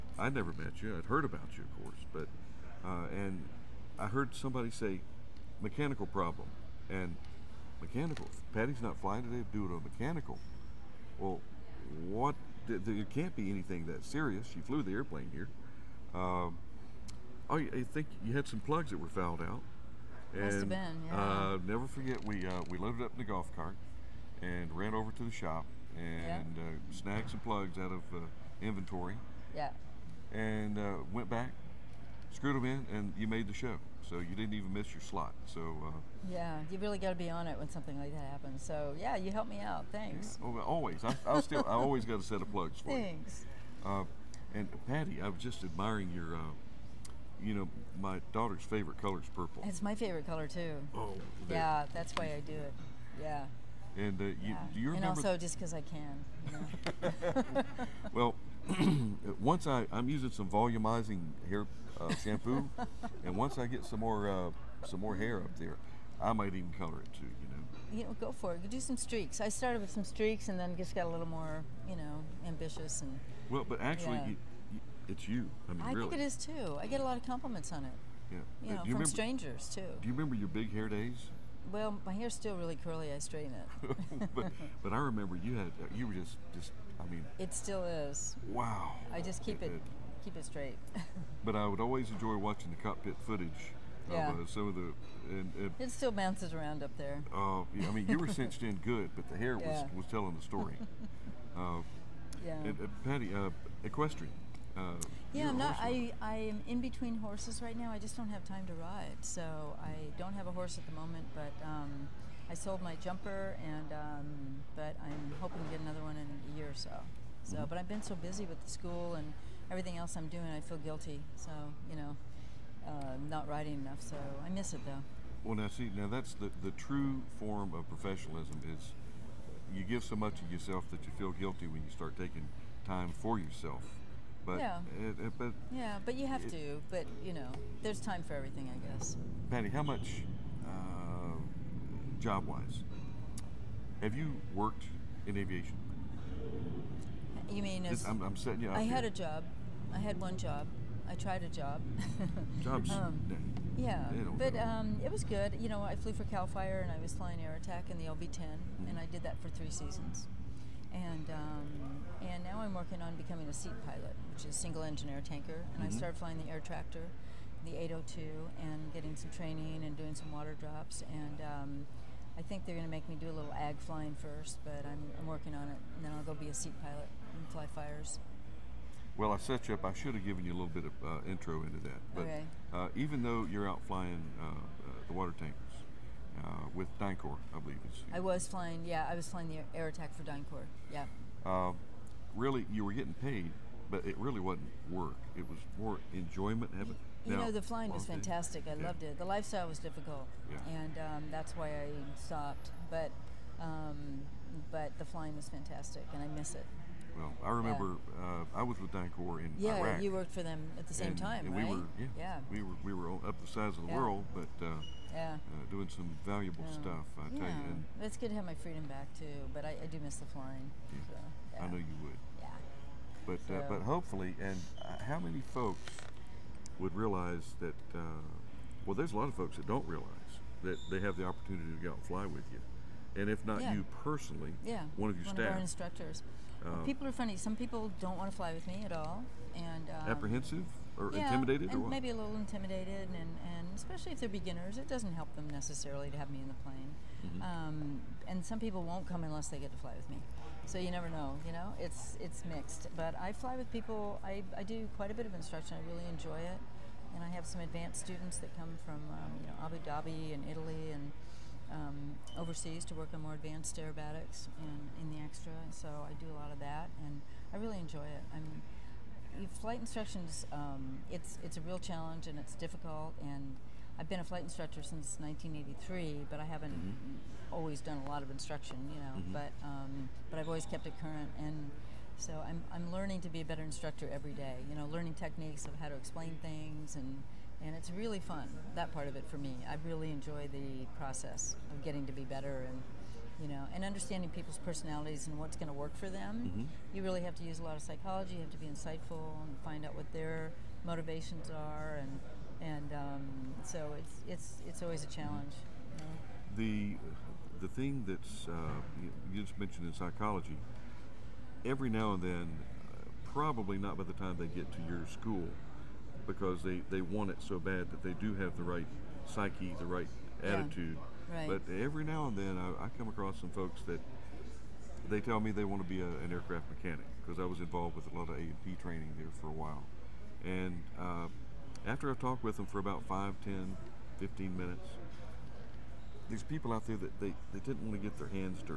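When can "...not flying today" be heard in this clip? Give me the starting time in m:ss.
0:08.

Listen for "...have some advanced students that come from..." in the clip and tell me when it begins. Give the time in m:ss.
4:17.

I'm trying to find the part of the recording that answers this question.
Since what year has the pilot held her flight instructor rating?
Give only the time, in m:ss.
4:35.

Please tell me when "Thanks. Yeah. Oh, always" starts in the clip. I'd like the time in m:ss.
0:39.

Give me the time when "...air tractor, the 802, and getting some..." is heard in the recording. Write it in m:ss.
2:46.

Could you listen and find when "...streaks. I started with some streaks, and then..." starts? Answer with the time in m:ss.
1:08.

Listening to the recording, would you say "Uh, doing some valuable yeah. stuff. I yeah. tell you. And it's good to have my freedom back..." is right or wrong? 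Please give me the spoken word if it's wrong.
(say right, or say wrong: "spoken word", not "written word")
right.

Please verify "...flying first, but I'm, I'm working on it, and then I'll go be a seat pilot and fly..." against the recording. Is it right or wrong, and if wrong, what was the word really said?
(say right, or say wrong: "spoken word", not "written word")
right.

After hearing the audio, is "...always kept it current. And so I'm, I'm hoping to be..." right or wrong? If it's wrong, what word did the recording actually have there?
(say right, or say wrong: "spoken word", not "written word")
wrong: "learning", not "hoping".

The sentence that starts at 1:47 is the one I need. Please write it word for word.
I just don't have time to ride, so I don't have a horse at the moment.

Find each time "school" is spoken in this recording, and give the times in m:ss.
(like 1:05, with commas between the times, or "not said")
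1:58, 5:15.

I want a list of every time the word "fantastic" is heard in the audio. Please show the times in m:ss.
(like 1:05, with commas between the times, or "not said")
3:18, 3:25.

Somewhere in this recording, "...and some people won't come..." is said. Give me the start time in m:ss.
4:08.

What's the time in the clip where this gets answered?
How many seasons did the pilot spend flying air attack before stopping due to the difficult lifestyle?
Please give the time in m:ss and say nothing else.
2:39.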